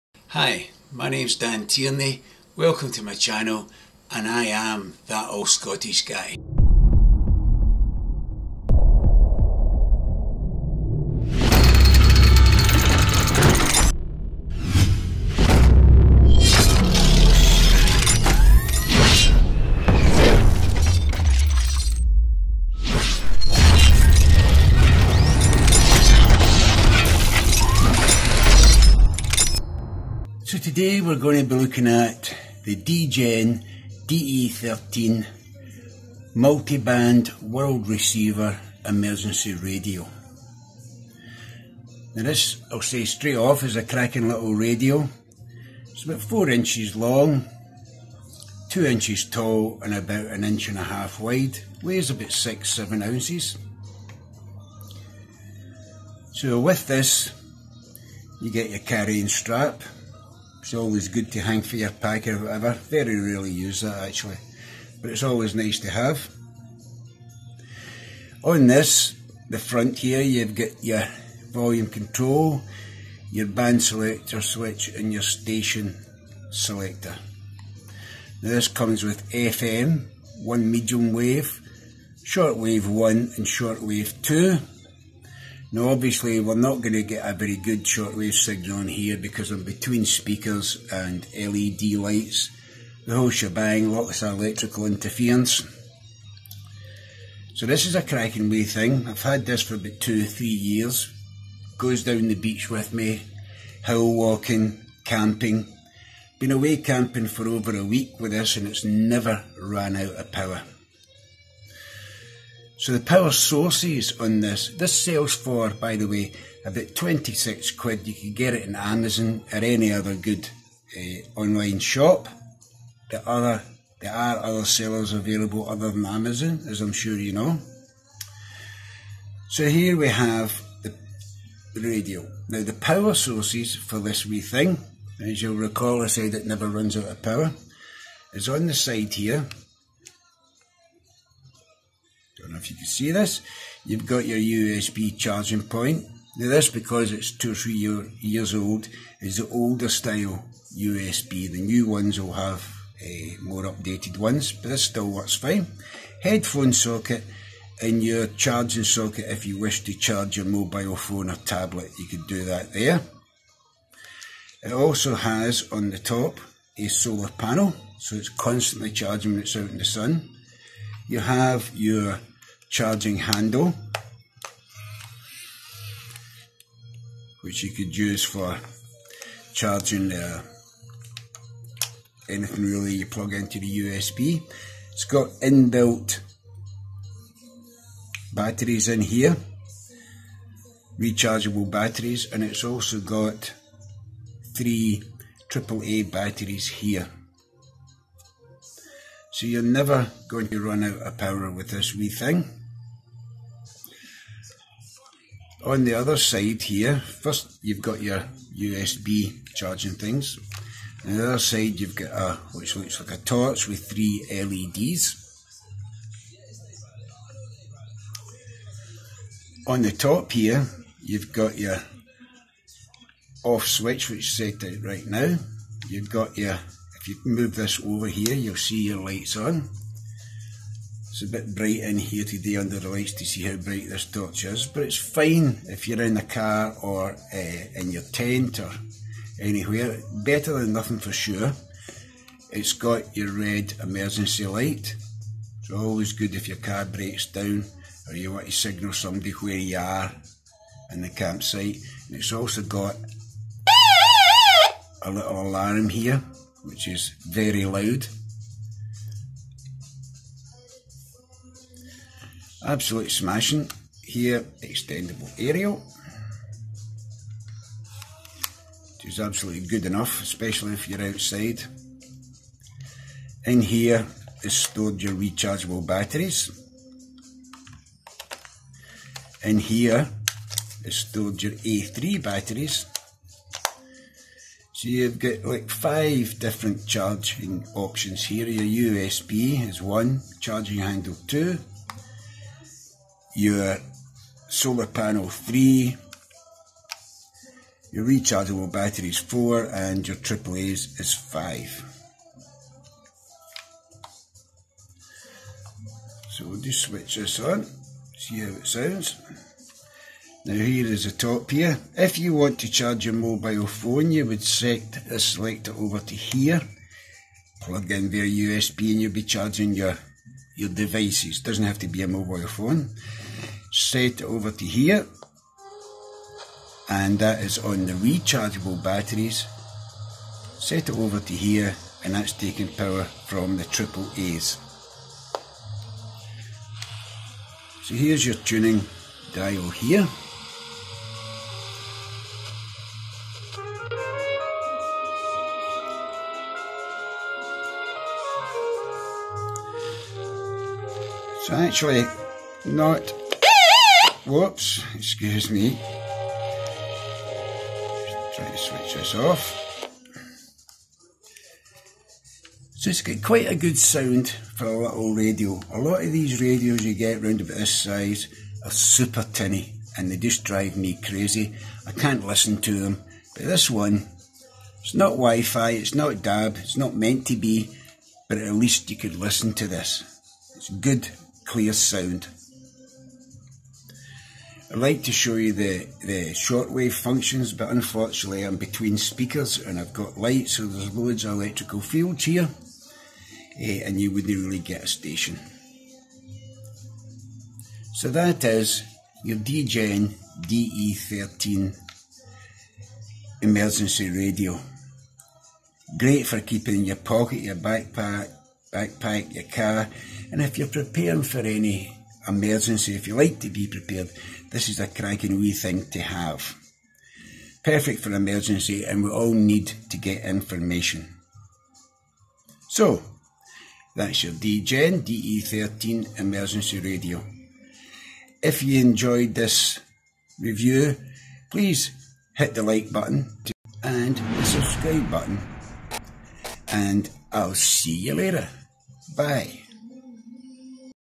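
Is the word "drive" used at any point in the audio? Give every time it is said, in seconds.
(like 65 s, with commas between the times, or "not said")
370 s.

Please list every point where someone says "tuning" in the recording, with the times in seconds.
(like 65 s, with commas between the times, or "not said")
338 s.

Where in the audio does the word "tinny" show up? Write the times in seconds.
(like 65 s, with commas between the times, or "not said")
369 s.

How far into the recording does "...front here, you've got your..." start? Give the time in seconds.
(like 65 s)
69 s.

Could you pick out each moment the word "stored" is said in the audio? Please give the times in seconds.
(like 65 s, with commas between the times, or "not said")
274 s, 280 s.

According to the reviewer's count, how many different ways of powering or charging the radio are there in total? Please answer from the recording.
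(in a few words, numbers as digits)
5.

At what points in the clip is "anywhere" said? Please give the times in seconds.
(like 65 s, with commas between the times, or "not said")
239 s.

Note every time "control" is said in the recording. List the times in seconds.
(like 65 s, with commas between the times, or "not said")
71 s.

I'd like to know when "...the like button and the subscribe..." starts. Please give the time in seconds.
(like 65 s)
432 s.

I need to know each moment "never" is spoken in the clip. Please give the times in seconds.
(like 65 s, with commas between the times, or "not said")
108 s, 136 s, 199 s.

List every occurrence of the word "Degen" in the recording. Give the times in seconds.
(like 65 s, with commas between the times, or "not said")
32 s, 399 s, 424 s.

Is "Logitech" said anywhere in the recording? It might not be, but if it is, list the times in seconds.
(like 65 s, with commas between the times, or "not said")
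not said.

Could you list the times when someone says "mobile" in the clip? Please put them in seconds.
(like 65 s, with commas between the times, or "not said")
160 s, 313 s, 322 s.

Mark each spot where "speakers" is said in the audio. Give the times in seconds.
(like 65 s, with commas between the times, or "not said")
90 s, 388 s.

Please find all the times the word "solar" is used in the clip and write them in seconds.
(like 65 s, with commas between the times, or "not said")
166 s, 294 s.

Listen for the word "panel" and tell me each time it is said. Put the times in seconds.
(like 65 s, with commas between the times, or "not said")
167 s, 294 s.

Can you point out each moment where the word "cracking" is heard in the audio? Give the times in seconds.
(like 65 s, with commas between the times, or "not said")
43 s, 98 s, 414 s.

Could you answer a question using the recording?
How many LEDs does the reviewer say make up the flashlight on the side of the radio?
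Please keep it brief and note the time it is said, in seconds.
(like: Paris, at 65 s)
3, at 213 s.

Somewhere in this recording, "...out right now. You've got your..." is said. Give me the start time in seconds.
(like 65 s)
224 s.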